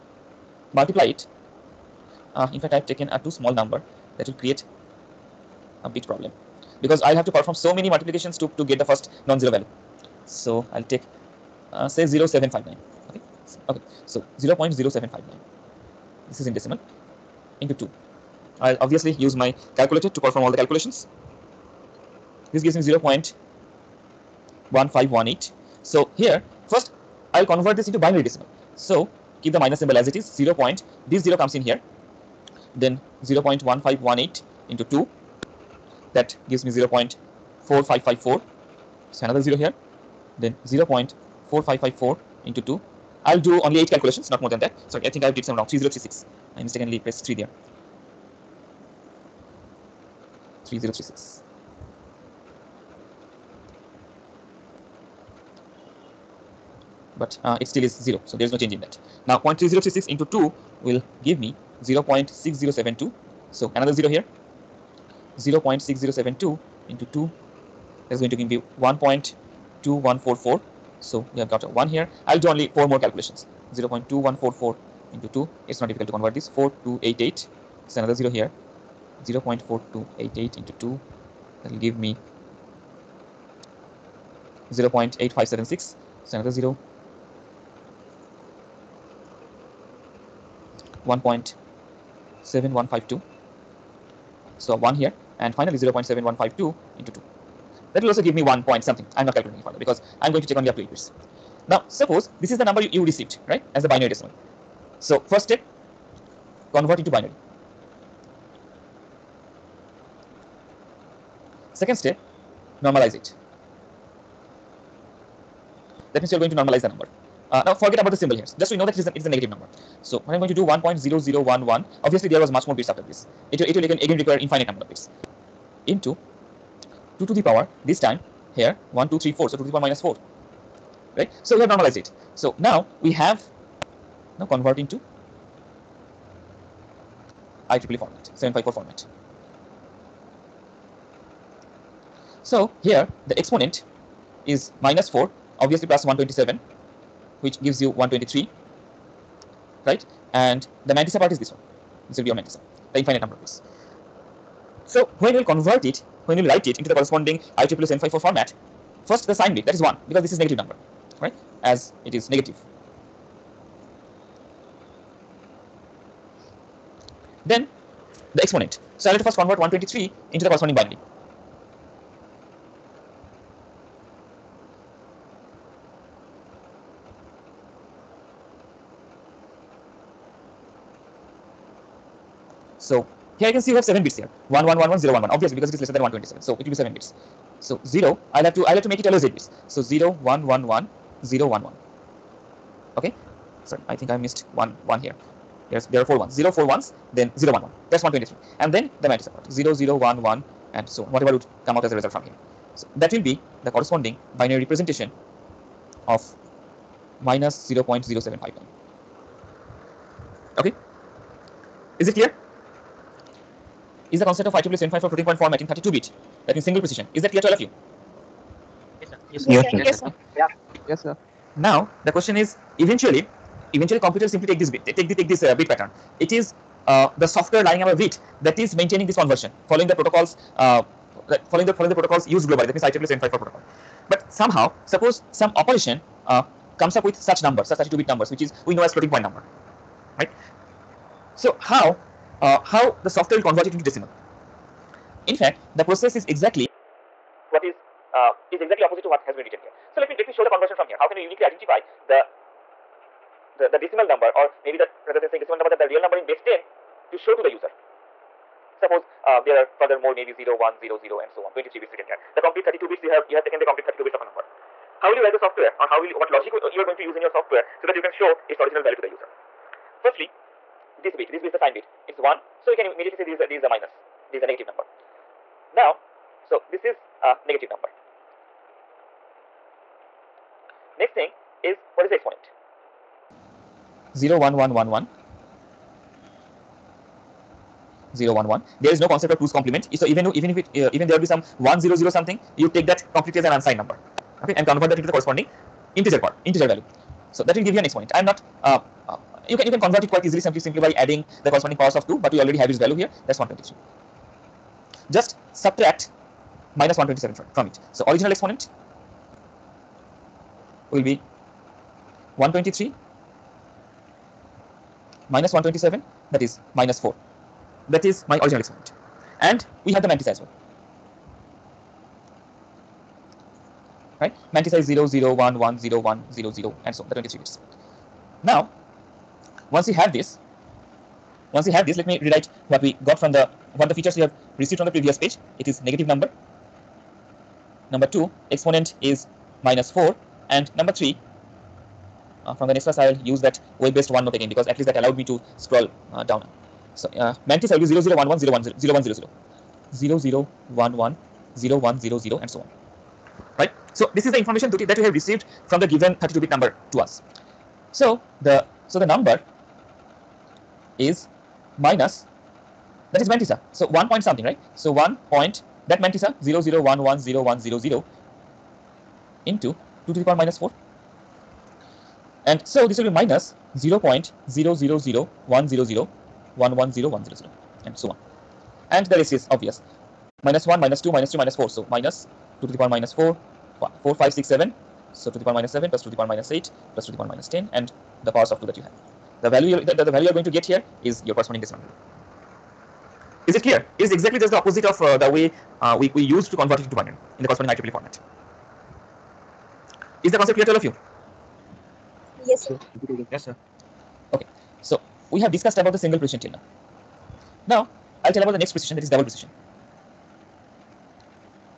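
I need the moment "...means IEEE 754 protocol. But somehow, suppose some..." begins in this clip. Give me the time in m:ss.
3:52.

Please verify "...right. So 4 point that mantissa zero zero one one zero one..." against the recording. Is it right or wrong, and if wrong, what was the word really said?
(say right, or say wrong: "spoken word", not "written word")
wrong: "1", not "4".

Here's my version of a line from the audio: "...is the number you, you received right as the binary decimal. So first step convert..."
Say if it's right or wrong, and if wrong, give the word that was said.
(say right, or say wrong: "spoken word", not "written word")
right.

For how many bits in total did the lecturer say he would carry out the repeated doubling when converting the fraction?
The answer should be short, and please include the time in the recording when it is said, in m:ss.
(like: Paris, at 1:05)
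8, at 0:43.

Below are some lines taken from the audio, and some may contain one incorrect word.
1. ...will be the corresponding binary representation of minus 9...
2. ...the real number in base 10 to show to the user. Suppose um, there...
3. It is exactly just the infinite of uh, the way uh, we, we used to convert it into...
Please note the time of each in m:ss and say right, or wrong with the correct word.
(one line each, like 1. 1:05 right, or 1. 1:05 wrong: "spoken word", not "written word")
1. 3:23 wrong: "0", not "9"
2. 4:15 right
3. 6:33 wrong: "opposite", not "infinite".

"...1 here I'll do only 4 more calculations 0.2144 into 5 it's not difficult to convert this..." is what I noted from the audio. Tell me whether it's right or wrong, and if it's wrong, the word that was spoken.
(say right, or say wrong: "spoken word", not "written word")
wrong: "2", not "5".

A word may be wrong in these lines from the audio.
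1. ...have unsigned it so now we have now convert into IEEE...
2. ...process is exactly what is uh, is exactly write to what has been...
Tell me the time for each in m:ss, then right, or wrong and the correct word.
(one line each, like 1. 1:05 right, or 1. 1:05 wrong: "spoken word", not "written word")
1. 2:11 wrong: "normalized", not "unsigned"
2. 4:05 wrong: "opposite", not "write".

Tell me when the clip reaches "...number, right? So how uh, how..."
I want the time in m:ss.
3:59.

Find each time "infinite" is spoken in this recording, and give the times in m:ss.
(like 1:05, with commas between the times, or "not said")
2:04, 2:32.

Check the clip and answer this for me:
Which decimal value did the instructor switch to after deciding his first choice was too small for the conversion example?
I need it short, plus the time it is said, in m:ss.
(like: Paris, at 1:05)
0.0759, at 0:11.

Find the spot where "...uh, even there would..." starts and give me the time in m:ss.
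4:50.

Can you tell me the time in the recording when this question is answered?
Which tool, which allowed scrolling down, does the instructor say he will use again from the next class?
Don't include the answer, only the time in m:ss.
5:43.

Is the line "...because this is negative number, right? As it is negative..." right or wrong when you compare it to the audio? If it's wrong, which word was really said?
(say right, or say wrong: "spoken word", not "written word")
right.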